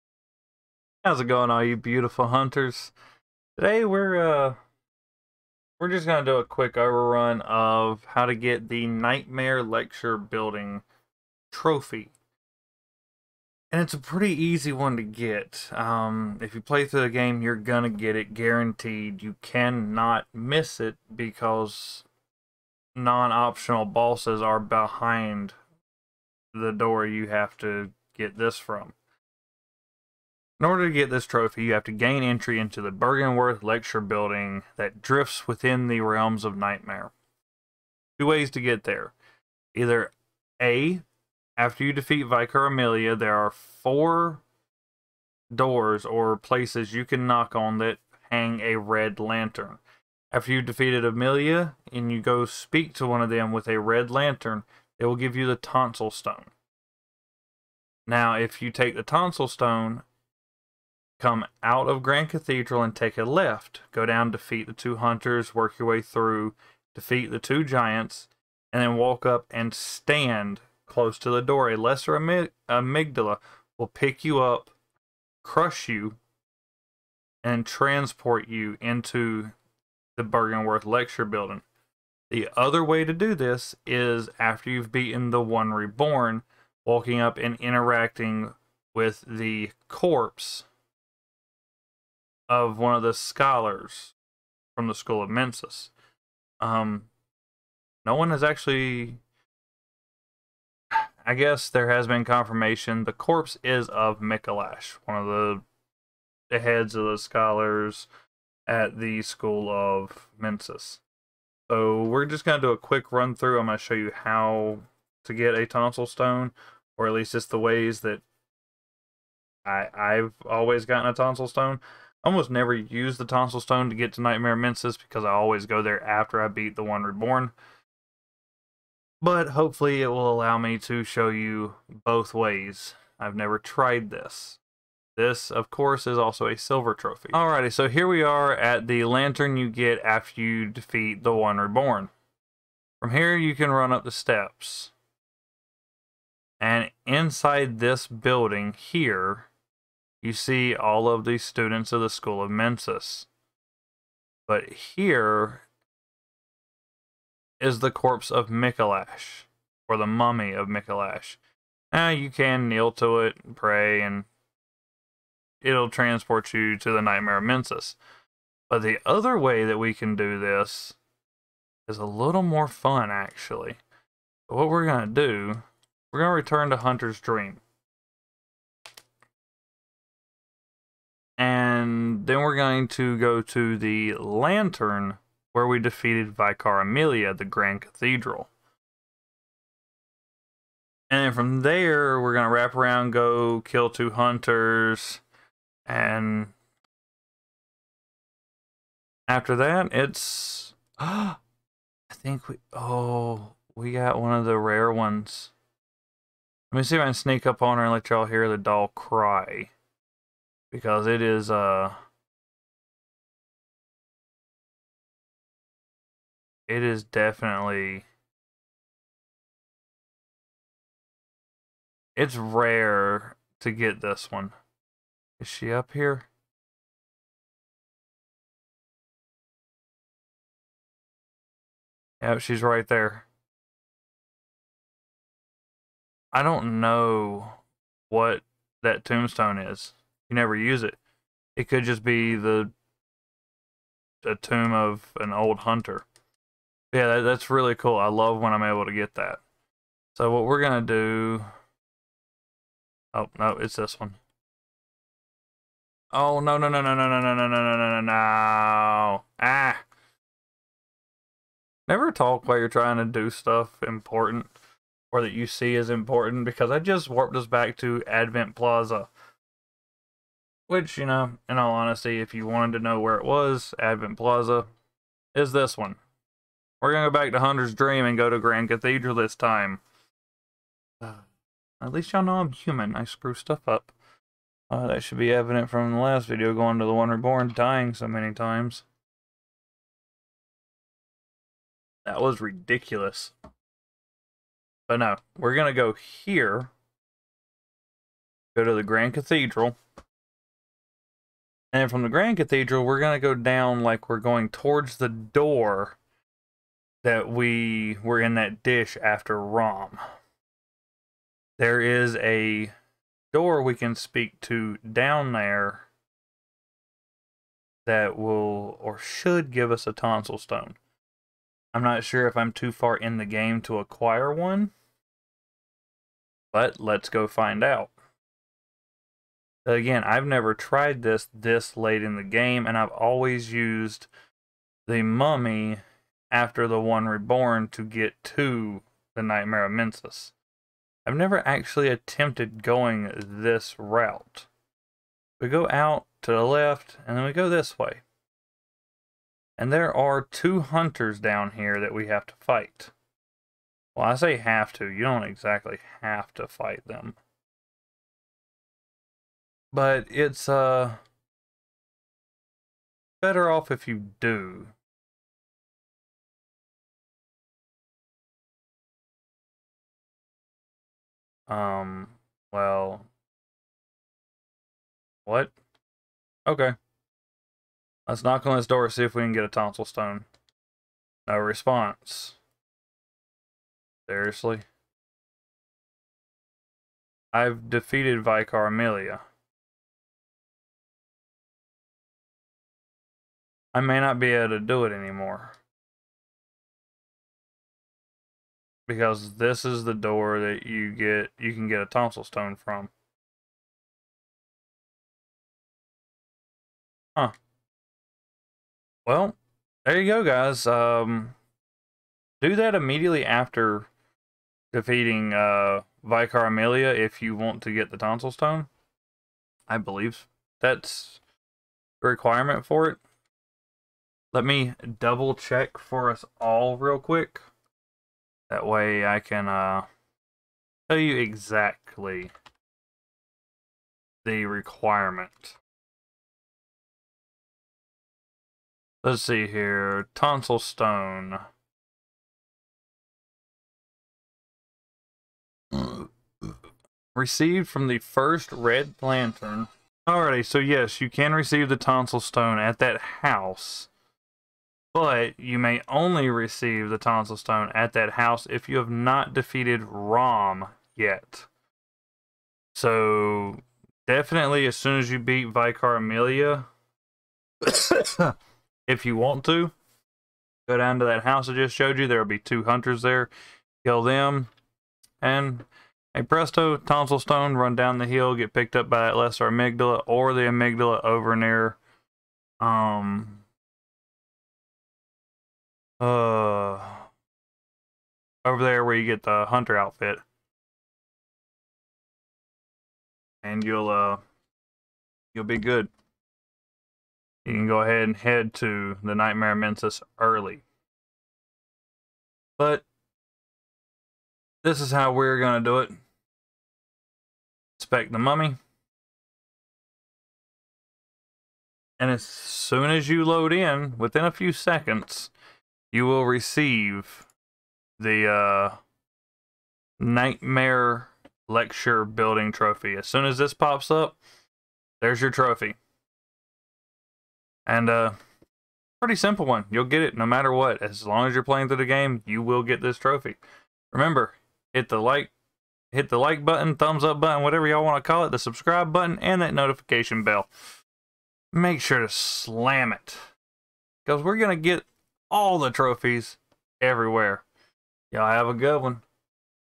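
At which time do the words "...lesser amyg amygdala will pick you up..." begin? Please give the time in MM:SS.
01:11.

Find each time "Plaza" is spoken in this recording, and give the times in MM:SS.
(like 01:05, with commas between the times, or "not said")
04:28, 04:34.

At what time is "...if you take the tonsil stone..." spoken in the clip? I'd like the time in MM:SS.
00:58.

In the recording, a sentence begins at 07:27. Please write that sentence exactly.
Received from the first red lantern.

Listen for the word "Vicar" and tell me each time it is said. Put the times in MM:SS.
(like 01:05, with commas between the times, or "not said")
00:42, 03:06, 06:28, 06:56, 07:45.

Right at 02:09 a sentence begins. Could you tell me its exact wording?
But hopefully it will allow me to show you both ways.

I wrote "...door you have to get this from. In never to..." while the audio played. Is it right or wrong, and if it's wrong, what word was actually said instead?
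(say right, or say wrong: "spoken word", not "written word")
wrong: "order", not "never".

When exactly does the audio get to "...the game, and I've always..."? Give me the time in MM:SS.
05:32.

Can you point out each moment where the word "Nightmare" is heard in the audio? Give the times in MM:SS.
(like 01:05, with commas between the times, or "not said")
00:08, 00:36, 02:04, 02:47, 05:39, 08:19, 08:39.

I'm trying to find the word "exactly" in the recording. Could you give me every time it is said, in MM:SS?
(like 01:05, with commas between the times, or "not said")
05:55, 07:11.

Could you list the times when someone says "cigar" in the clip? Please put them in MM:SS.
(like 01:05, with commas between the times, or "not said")
not said.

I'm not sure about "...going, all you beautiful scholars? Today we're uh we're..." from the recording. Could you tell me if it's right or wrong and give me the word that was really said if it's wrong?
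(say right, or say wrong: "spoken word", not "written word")
wrong: "hunters", not "scholars".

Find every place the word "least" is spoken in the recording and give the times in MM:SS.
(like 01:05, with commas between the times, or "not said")
01:57, 04:41.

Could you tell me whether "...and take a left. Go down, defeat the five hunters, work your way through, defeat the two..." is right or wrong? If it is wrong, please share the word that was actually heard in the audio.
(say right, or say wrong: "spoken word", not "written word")
wrong: "two", not "five".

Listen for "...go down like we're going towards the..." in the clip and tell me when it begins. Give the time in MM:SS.
05:03.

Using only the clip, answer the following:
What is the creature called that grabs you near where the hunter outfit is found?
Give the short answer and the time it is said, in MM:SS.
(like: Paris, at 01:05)
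lesser amygdala, at 07:59.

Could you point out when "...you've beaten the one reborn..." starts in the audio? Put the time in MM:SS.
01:24.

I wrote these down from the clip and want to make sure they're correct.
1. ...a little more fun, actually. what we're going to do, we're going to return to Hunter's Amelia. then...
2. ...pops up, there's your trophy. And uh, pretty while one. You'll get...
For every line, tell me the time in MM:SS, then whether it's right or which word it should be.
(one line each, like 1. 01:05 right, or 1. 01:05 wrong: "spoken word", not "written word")
1. 02:51 wrong: "Dream", not "Amelia"
2. 08:43 wrong: "simple", not "while".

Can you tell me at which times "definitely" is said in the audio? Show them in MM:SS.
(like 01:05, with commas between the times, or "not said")
03:37, 07:44.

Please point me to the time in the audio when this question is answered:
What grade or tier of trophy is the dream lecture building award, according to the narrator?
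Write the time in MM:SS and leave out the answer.
02:16.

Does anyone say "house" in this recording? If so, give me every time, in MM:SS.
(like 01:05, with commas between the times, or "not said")
07:33, 07:38, 07:51.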